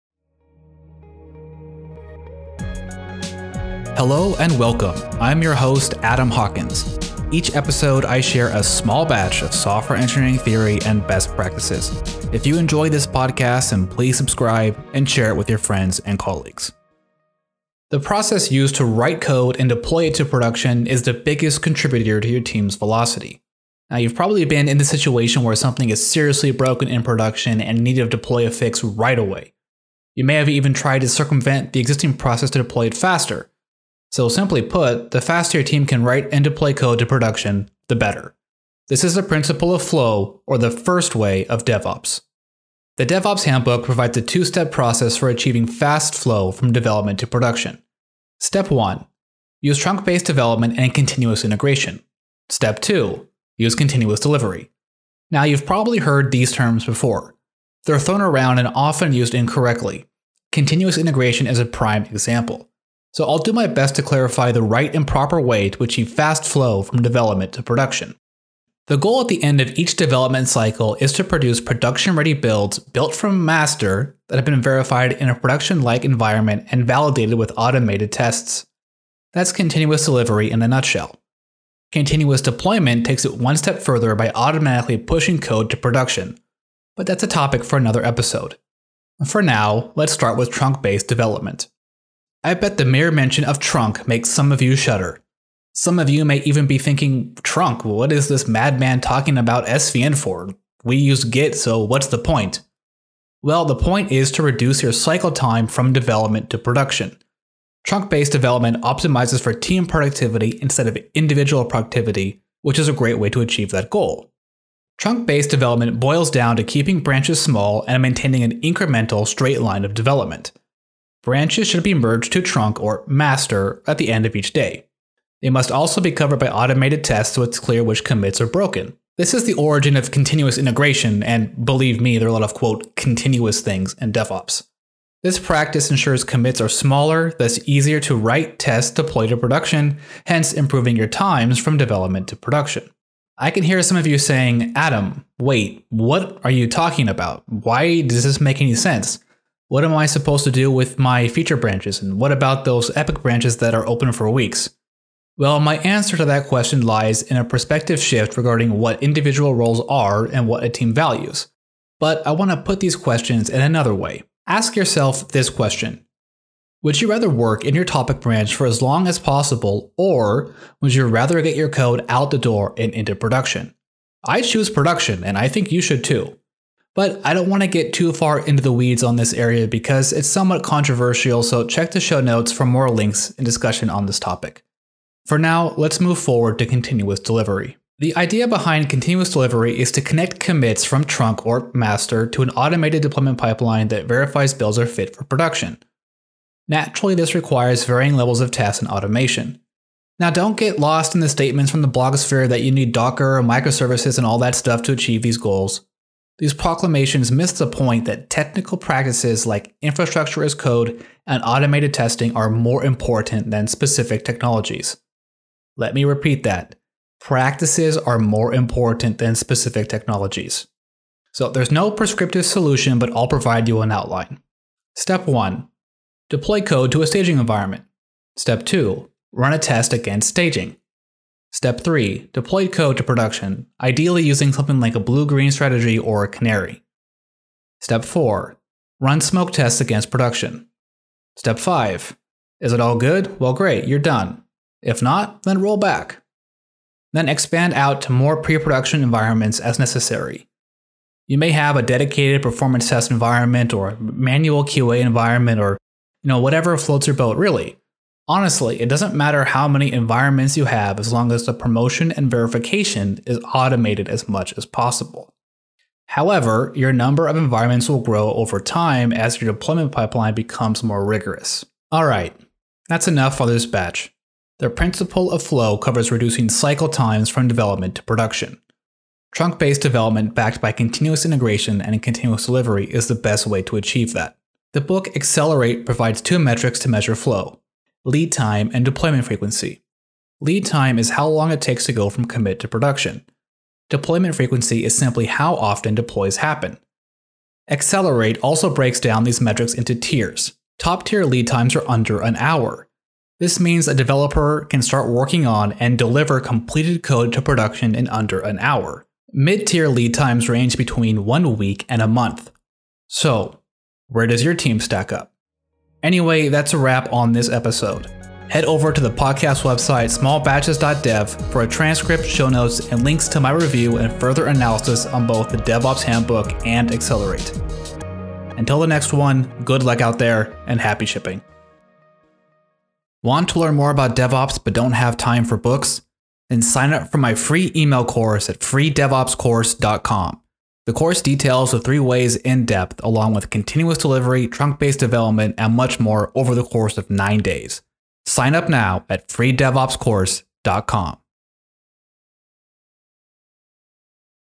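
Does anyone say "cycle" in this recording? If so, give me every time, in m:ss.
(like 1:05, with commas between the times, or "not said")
1:10, 1:44, 4:36.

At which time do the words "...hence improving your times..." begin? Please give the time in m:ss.
2:20.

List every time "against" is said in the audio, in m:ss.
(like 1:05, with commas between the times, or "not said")
3:49, 3:59.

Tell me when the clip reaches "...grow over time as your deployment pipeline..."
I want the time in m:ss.
4:28.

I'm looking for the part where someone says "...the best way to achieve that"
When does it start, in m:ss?
4:43.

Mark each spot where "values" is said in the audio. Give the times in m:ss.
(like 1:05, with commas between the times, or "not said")
2:40.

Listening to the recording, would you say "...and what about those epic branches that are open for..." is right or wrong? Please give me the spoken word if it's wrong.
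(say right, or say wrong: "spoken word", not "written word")
right.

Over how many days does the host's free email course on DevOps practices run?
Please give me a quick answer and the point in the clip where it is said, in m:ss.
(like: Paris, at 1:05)
9, at 5:47.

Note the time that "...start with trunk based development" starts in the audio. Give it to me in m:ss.
1:30.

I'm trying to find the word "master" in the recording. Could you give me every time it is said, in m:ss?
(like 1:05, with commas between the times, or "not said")
1:13, 2:03, 3:11.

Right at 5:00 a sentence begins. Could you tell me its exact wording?
Top tier lead times are under an hour.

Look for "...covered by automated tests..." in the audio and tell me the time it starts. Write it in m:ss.
2:06.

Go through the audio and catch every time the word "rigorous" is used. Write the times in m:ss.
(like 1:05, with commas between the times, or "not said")
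4:31.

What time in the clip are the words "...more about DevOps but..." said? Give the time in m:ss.
5:33.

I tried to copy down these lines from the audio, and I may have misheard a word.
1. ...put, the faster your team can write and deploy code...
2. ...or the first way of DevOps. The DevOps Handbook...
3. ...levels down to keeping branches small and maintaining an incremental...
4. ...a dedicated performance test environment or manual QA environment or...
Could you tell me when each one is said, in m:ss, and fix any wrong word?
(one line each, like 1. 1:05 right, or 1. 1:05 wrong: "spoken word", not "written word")
1. 0:34 right
2. 0:40 right
3. 1:55 wrong: "boils", not "levels"
4. 4:11 right.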